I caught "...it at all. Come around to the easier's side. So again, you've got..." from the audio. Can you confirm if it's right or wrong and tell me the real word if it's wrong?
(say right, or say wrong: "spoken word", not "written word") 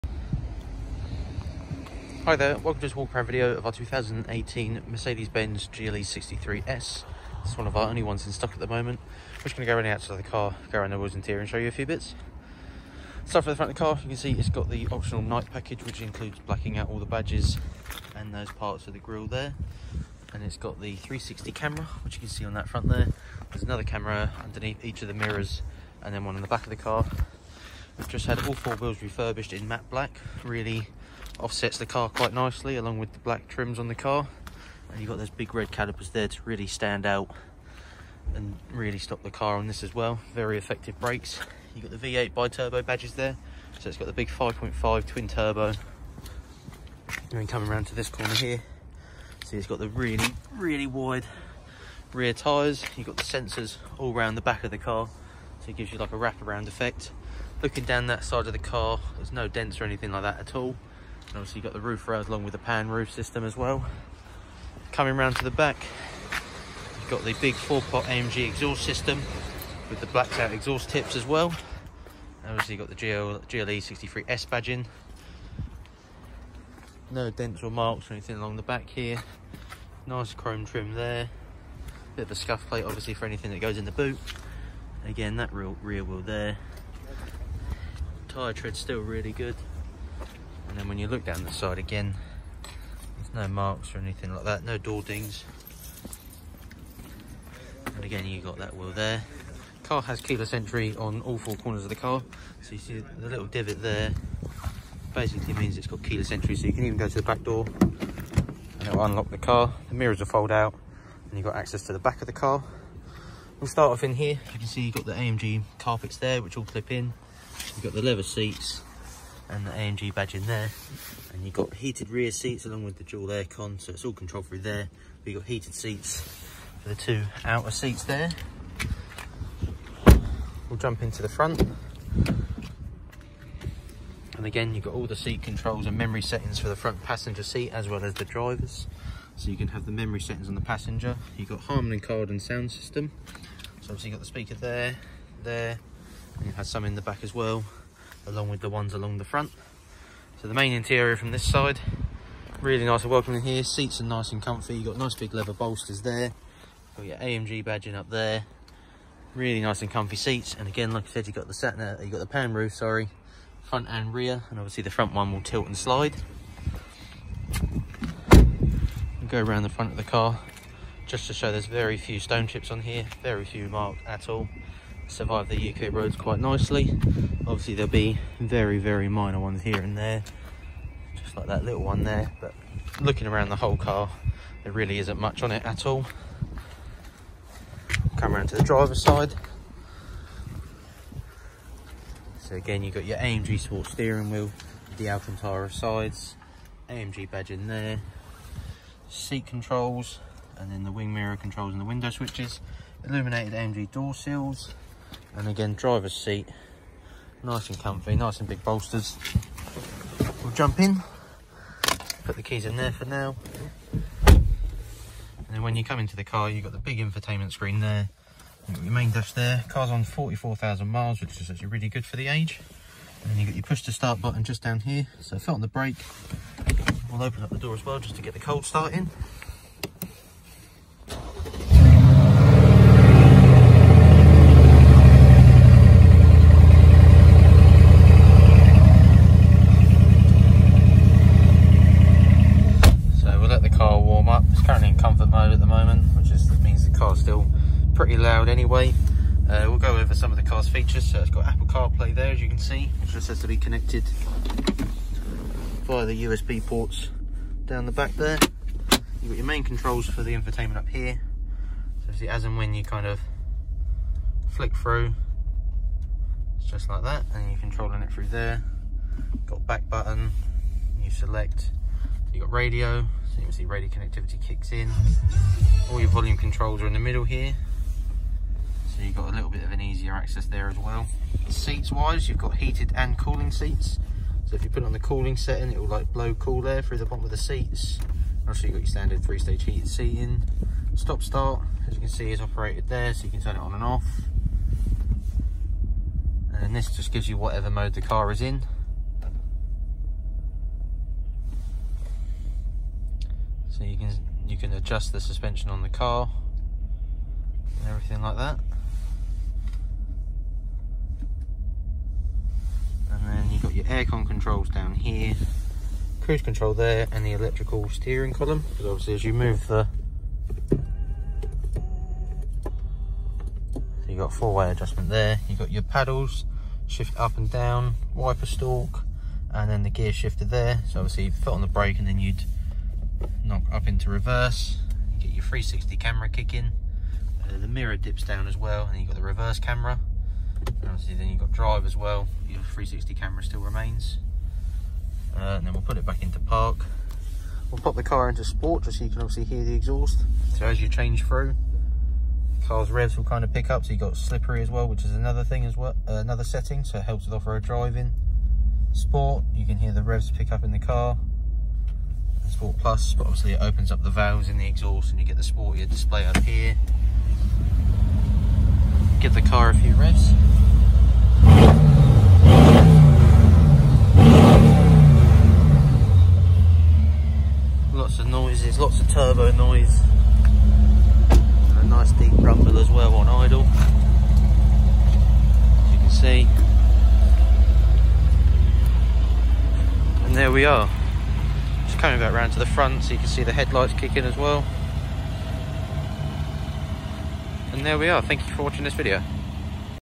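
wrong: "driver", not "easier".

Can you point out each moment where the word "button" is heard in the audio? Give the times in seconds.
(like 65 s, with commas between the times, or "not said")
224 s, 269 s.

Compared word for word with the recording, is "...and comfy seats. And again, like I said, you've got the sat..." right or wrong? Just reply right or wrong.
right.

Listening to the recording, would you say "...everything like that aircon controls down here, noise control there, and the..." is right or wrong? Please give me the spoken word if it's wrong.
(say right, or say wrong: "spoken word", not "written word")
wrong: "cruise", not "noise".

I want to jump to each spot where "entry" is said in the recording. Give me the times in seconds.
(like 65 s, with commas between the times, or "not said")
100 s, 106 s.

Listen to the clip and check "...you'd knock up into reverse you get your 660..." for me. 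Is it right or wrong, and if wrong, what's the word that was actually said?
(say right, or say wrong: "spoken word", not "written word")
wrong: "360", not "660".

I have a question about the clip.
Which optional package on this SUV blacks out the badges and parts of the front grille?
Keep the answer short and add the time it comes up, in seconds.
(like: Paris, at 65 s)
Night package, at 15 s.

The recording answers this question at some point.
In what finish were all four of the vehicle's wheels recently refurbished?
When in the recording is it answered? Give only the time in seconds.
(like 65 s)
29 s.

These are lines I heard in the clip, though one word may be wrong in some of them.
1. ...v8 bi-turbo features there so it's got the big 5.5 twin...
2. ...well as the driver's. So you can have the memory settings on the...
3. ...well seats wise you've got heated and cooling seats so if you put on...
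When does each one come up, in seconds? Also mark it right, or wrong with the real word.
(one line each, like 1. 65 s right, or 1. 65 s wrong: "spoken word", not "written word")
1. 42 s wrong: "badges", not "features"
2. 137 s right
3. 280 s right.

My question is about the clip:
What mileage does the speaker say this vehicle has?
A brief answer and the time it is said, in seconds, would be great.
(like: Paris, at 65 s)
44,000 miles, at 220 s.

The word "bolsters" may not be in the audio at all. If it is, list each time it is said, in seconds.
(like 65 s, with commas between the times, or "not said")
155 s, 208 s.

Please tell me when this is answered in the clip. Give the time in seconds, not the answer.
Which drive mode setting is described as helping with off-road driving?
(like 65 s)
354 s.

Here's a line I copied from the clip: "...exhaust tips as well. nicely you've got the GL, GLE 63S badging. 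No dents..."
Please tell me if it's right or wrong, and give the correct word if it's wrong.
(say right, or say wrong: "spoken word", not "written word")
wrong: "obviously", not "nicely".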